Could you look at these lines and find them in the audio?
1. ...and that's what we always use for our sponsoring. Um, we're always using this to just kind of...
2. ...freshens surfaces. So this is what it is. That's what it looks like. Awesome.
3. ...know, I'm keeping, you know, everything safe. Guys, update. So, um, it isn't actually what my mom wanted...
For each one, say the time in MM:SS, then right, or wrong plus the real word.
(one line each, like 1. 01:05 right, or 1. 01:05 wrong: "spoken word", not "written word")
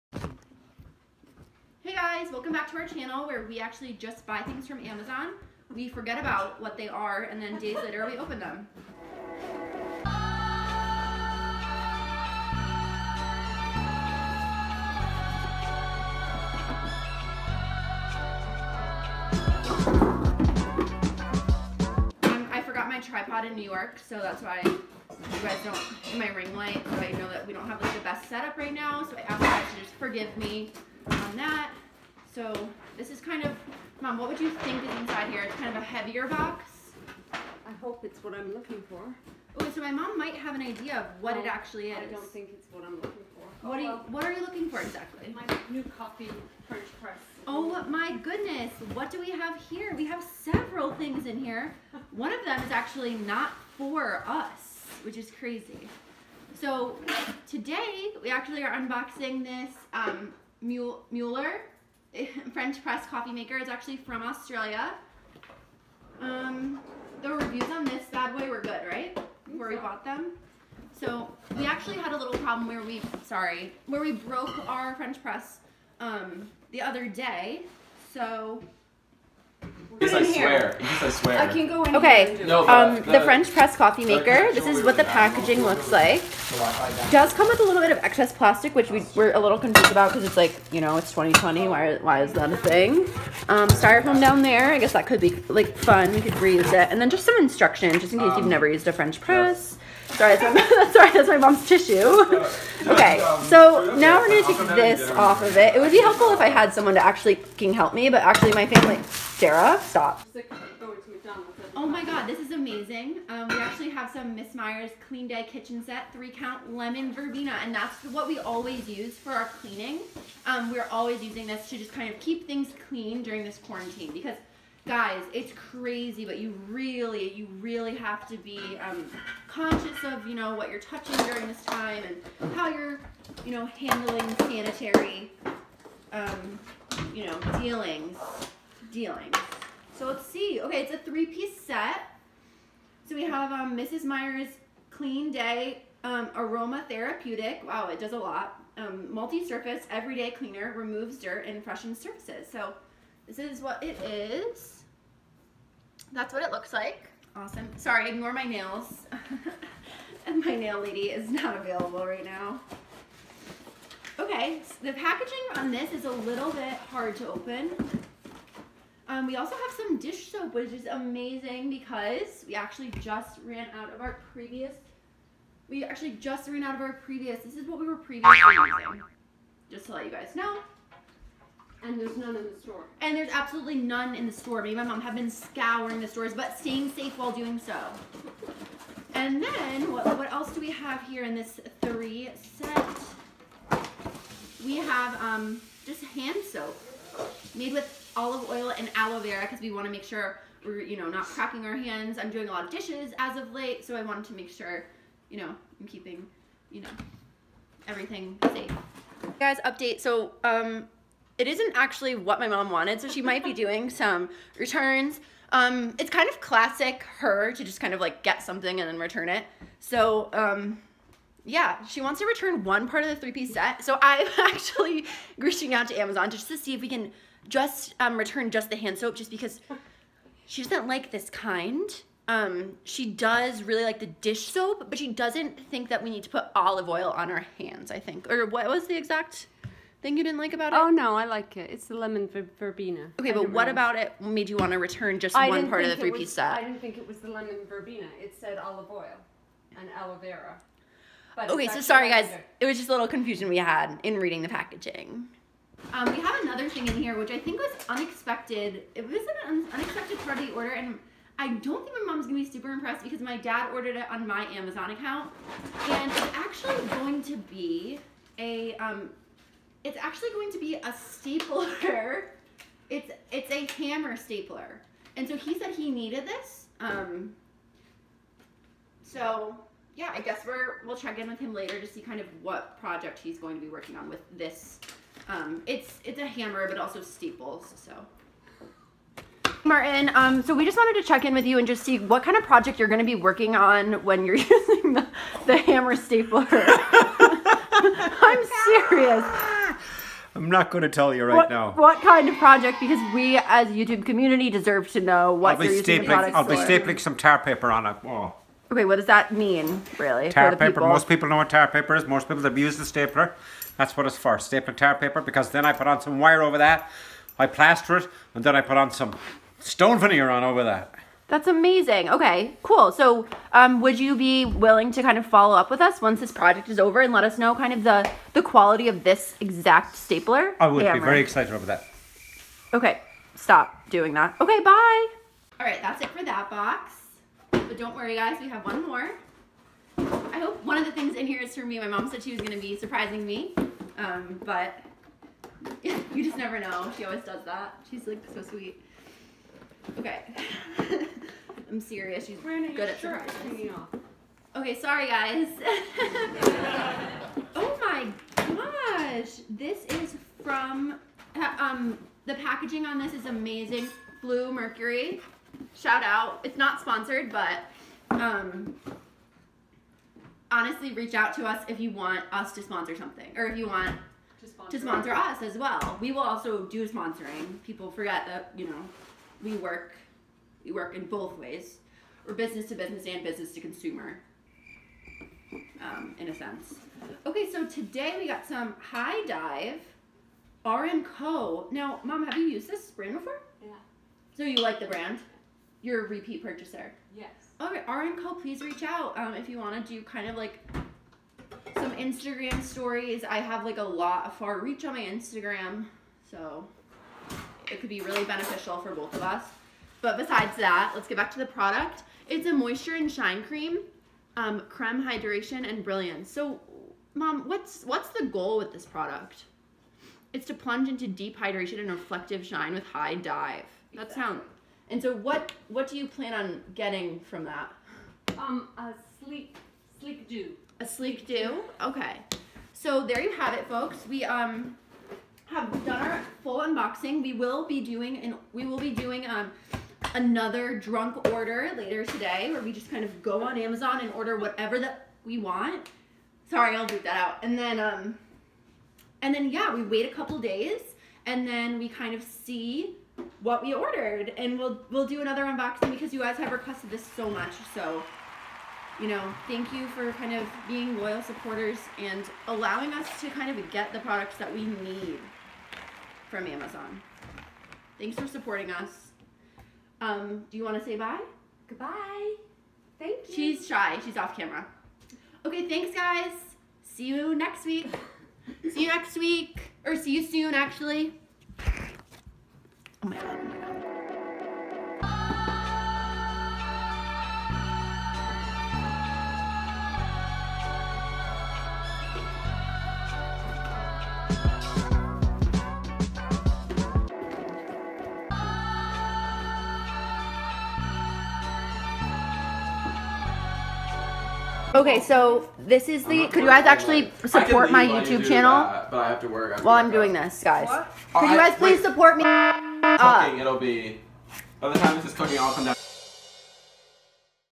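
1. 01:57 wrong: "cleaning", not "sponsoring"
2. 02:31 right
3. 03:25 right.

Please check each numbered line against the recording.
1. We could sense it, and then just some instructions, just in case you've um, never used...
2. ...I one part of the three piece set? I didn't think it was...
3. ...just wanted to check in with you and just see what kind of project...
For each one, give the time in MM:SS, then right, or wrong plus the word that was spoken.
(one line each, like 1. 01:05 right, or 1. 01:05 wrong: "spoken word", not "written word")
1. 01:36 wrong: "reuse", not "sense"
2. 04:05 right
3. 04:50 right.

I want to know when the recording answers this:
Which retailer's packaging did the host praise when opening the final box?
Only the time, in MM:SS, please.
06:04.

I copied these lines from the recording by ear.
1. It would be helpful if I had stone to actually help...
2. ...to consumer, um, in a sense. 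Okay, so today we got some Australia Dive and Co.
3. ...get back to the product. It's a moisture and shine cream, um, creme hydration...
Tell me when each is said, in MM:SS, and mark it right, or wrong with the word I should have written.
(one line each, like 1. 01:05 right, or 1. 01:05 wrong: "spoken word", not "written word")
1. 01:45 wrong: "someone", not "stone"
2. 06:23 wrong: "High", not "Australia"
3. 06:51 right.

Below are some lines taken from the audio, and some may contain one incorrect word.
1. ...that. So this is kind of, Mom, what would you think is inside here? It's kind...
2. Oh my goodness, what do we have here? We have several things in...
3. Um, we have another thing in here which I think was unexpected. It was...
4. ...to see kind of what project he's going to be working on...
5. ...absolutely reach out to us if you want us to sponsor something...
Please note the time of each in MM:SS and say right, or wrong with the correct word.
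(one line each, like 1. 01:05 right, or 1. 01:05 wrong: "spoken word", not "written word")
1. 00:31 right
2. 00:47 right
3. 04:15 right
4. 04:41 right
5. 06:10 wrong: "honestly", not "absolutely".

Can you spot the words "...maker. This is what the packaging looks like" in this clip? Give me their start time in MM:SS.
01:24.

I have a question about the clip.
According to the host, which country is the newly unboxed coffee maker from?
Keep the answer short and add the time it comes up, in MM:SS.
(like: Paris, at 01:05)
Australia, at 01:04.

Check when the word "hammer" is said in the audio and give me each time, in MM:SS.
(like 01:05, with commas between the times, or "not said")
04:33, 04:46, 04:55, 05:30.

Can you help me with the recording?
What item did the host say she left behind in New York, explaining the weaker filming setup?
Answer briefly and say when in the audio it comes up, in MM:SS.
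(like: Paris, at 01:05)
tripod, at 00:22.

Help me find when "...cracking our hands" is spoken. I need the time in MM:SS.
03:21.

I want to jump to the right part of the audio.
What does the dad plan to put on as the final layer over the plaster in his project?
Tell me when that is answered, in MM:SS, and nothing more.
05:19.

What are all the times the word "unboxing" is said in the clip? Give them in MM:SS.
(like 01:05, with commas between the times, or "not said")
00:58, 07:16, 07:35.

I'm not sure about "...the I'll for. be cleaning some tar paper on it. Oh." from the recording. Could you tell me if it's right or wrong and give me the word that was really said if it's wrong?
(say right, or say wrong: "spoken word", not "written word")
wrong: "stapling", not "cleaning".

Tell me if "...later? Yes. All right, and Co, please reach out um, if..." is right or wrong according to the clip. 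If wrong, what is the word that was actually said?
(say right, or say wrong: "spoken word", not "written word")
wrong: "purchaser", not "later".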